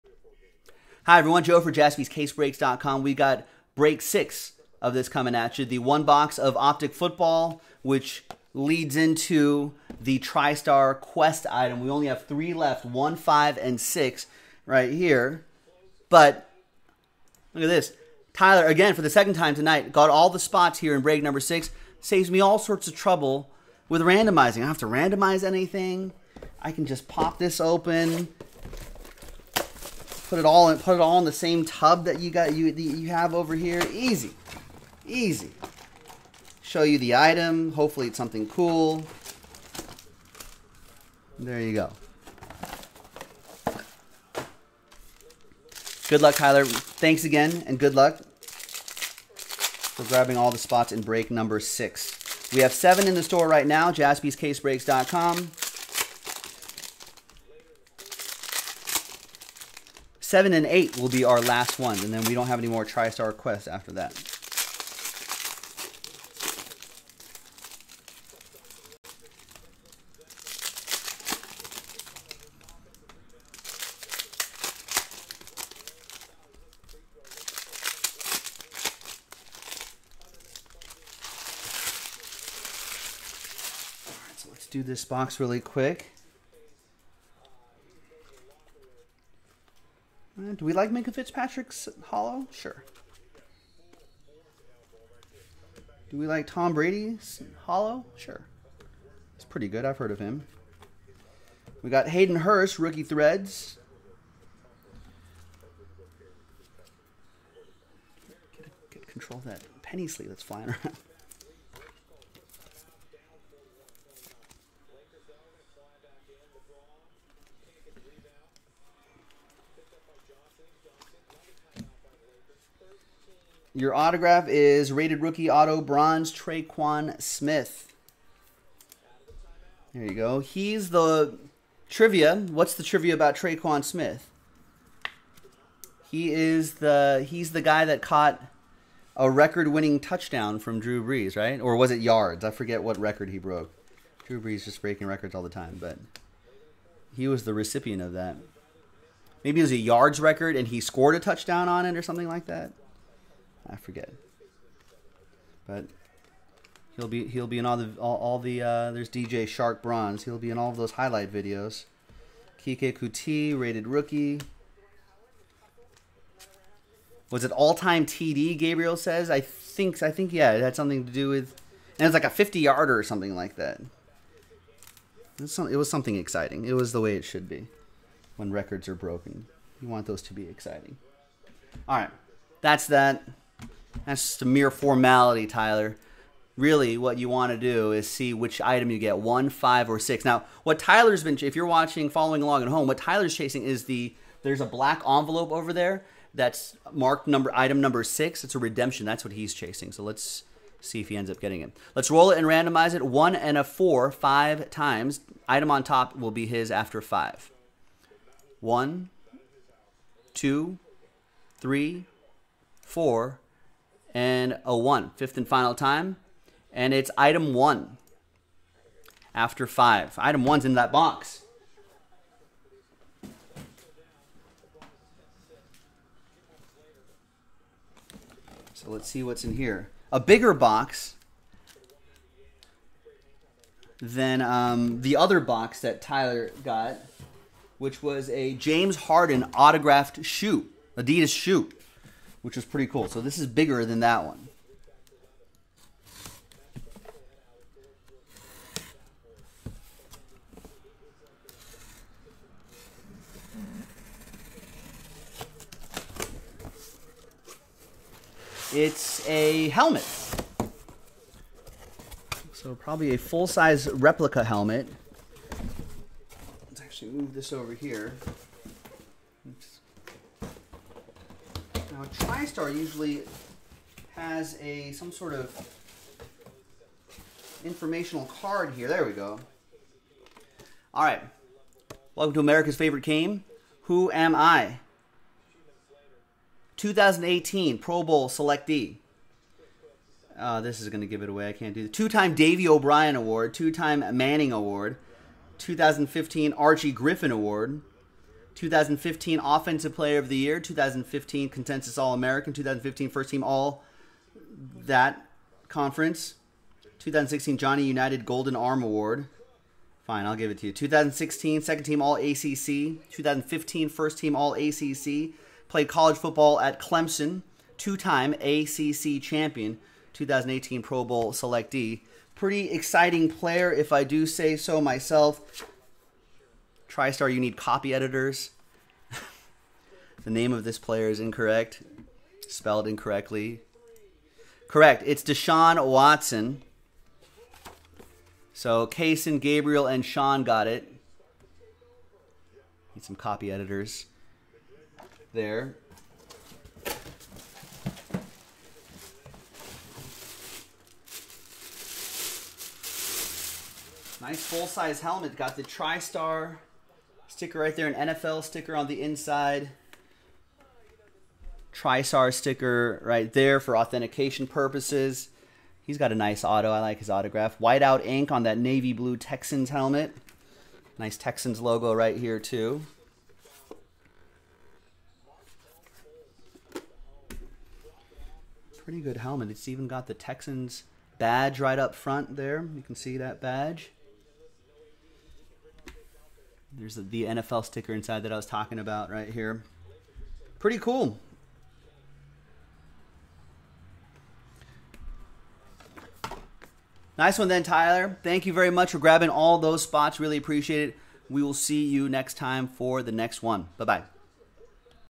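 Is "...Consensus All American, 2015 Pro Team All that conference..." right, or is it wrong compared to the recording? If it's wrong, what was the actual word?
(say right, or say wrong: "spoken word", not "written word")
wrong: "First", not "Pro".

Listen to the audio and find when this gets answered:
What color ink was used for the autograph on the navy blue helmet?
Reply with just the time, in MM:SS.
06:07.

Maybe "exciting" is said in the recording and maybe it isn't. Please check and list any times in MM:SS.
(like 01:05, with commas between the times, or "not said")
02:56, 03:00, 05:22.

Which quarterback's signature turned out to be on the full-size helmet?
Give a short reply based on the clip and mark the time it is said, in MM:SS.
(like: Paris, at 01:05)
Deshaun Watson, at 05:35.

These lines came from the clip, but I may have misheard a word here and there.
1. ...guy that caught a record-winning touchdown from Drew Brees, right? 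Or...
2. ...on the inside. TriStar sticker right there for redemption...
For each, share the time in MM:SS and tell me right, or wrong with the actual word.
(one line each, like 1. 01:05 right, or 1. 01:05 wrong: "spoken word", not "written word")
1. 02:17 right
2. 05:58 wrong: "authentication", not "redemption".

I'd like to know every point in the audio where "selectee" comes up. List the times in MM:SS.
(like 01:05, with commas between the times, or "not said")
04:48, 05:21.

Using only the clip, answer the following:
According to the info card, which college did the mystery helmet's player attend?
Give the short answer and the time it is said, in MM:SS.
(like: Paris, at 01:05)
Clemson, at 05:16.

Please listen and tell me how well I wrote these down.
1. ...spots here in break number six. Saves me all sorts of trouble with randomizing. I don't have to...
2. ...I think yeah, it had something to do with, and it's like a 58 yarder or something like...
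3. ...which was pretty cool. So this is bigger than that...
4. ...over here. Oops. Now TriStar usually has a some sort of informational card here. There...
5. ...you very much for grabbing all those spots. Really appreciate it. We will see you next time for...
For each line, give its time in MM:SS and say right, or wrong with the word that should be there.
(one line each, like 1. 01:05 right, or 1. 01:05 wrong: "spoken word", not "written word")
1. 00:20 right
2. 02:50 wrong: "50", not "58"
3. 04:02 right
4. 04:27 right
5. 06:38 right.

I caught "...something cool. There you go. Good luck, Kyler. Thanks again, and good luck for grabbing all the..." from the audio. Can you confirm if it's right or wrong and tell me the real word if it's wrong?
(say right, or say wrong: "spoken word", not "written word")
right.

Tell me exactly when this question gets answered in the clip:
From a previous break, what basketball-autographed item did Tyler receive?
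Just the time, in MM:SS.
03:58.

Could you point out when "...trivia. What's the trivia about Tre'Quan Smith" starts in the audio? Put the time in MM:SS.
02:11.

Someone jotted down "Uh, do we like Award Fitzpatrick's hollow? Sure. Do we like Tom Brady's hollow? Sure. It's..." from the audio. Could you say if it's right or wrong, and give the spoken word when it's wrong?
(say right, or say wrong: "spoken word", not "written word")
wrong: "Minkah", not "Award".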